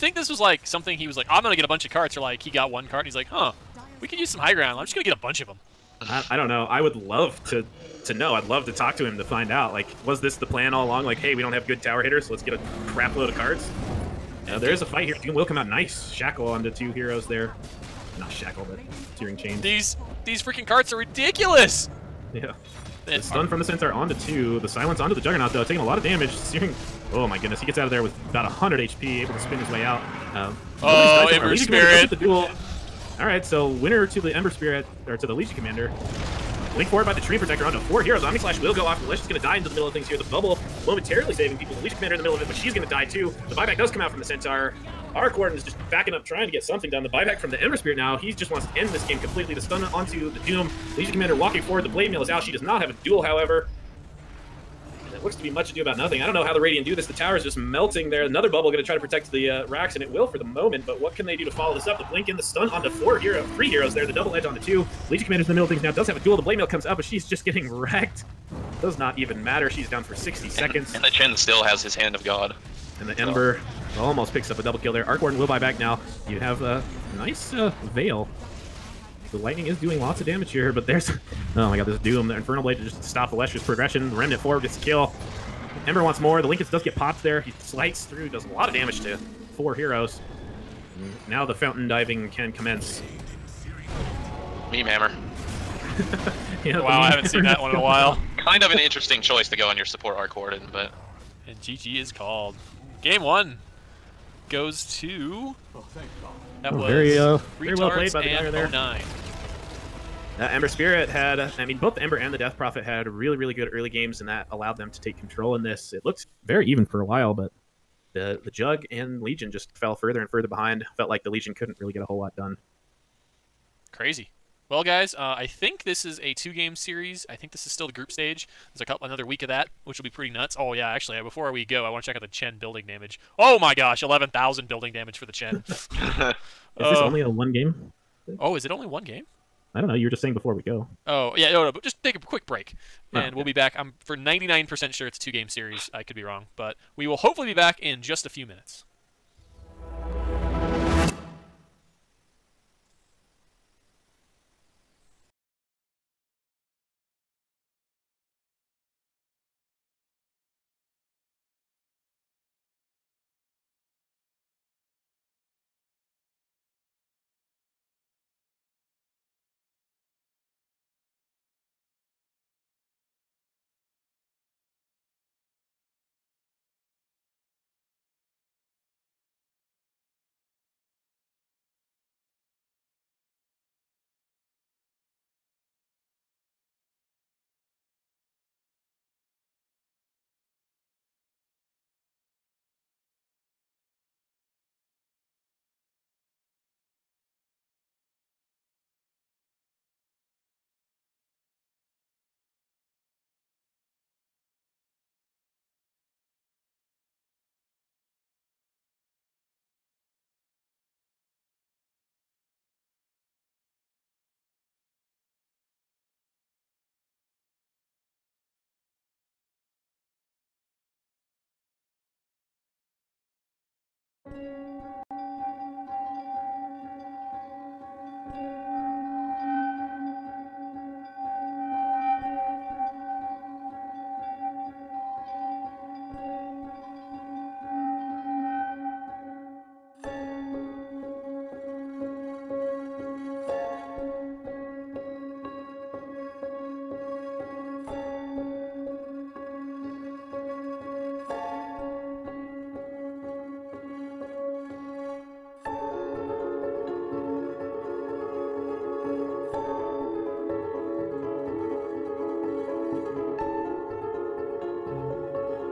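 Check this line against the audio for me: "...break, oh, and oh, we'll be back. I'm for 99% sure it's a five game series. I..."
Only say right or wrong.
wrong.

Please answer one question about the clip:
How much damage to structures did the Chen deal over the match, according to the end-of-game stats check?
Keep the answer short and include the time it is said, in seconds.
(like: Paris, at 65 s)
11,000, at 134 s.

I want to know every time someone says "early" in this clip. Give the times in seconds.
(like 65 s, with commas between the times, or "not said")
113 s.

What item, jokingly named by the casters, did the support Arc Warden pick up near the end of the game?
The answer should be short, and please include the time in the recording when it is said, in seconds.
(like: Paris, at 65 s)
Meme hammer, at 94 s.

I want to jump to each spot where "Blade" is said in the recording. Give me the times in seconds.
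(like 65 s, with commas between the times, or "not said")
51 s, 66 s, 82 s.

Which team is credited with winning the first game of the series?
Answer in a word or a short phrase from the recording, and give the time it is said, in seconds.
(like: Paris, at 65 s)
oNine, at 108 s.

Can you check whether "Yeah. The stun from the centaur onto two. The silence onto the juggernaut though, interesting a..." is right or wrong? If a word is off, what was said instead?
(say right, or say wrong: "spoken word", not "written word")
wrong: "taking", not "interesting".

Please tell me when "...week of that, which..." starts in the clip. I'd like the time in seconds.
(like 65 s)
129 s.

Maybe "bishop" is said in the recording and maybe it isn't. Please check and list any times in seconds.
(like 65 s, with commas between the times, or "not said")
not said.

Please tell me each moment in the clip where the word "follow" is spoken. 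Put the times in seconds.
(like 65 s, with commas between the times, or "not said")
61 s.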